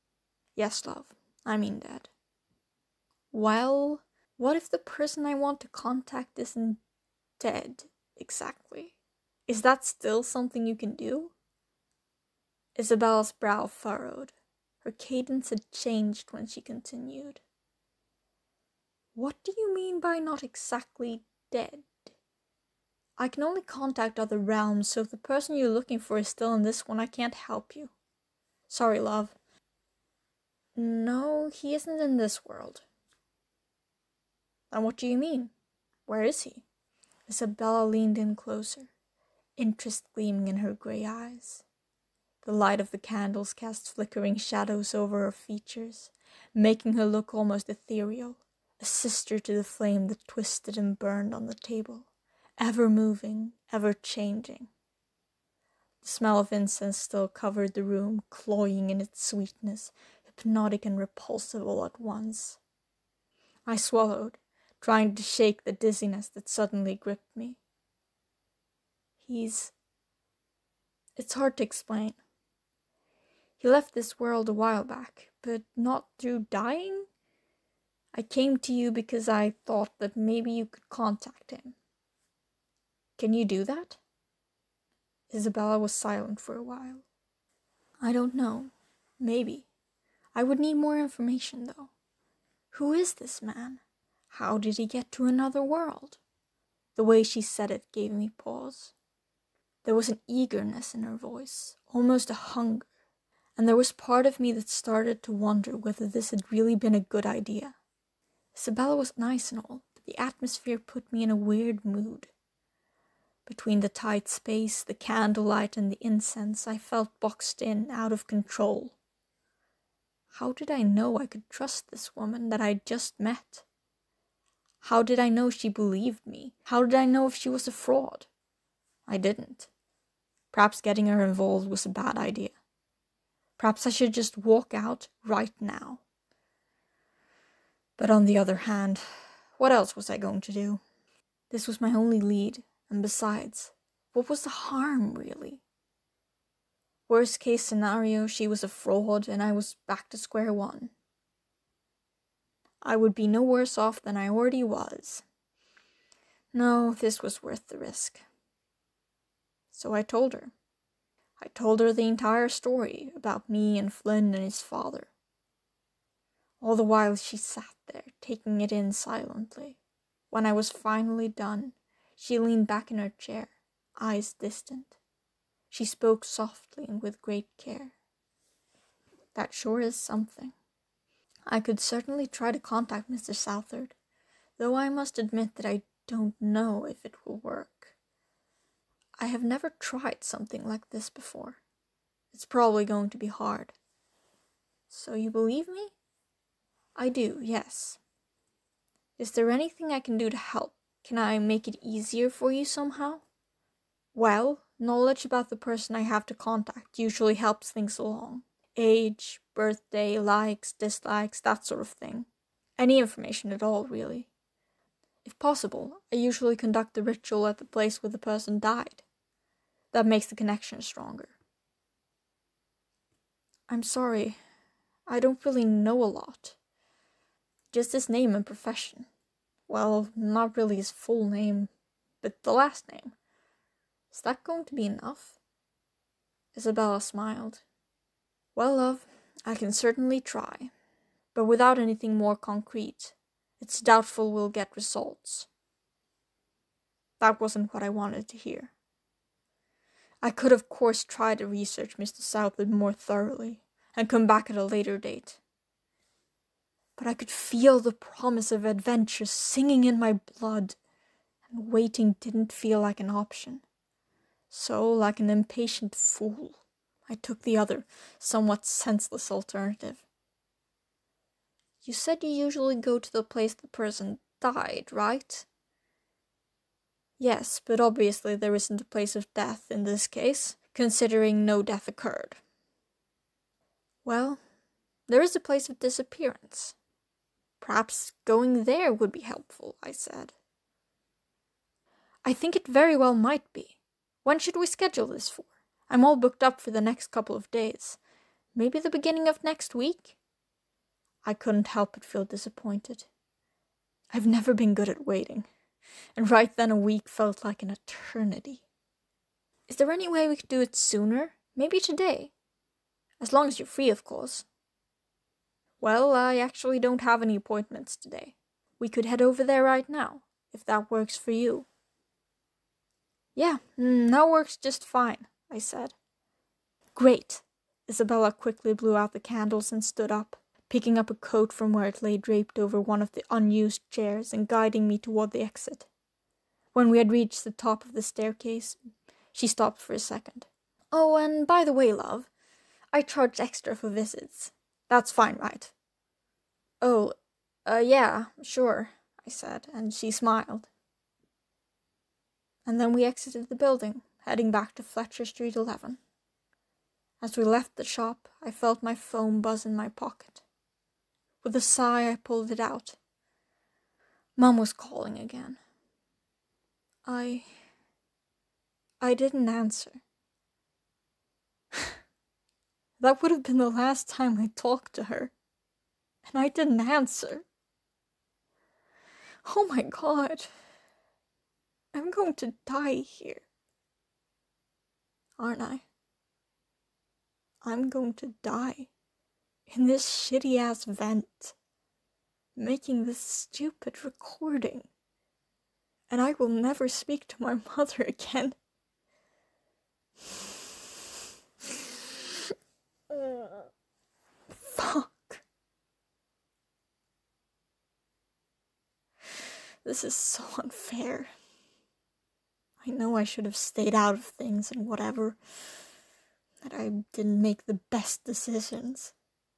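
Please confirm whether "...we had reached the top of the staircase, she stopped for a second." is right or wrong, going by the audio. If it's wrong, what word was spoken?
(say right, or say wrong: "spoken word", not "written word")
right.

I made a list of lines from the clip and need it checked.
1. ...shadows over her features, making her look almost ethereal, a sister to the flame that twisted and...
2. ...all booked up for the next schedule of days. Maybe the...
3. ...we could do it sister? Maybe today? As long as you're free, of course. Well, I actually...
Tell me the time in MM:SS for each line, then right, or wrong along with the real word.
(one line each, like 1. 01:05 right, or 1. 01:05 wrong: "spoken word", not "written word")
1. 00:44 right
2. 04:56 wrong: "couple", not "schedule"
3. 05:10 wrong: "sooner", not "sister".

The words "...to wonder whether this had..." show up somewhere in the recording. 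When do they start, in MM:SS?
01:45.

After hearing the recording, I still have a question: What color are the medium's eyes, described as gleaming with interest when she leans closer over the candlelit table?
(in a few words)
grey.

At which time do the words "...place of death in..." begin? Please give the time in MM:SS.
04:38.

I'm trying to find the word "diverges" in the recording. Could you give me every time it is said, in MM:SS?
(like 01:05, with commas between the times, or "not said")
not said.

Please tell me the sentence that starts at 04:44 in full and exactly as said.
Well, there is a place of disappearance.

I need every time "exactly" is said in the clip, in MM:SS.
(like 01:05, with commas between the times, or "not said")
00:08, 00:20.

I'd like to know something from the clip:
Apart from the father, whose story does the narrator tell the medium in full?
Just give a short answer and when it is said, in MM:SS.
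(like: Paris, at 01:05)
Flynn, at 02:43.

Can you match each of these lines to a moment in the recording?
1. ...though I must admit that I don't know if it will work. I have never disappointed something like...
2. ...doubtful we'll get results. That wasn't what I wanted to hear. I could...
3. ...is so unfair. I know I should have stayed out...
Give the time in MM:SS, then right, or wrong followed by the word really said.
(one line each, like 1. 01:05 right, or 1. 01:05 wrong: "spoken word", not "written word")
1. 03:04 wrong: "tried", not "disappointed"
2. 04:03 right
3. 06:50 right.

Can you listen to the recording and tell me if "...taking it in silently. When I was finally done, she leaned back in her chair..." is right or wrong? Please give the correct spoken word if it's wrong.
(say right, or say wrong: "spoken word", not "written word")
right.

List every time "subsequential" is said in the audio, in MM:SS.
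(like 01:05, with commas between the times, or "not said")
not said.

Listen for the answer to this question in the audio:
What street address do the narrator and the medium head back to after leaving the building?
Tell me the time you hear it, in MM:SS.
05:54.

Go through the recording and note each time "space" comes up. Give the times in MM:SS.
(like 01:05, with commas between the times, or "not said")
01:54.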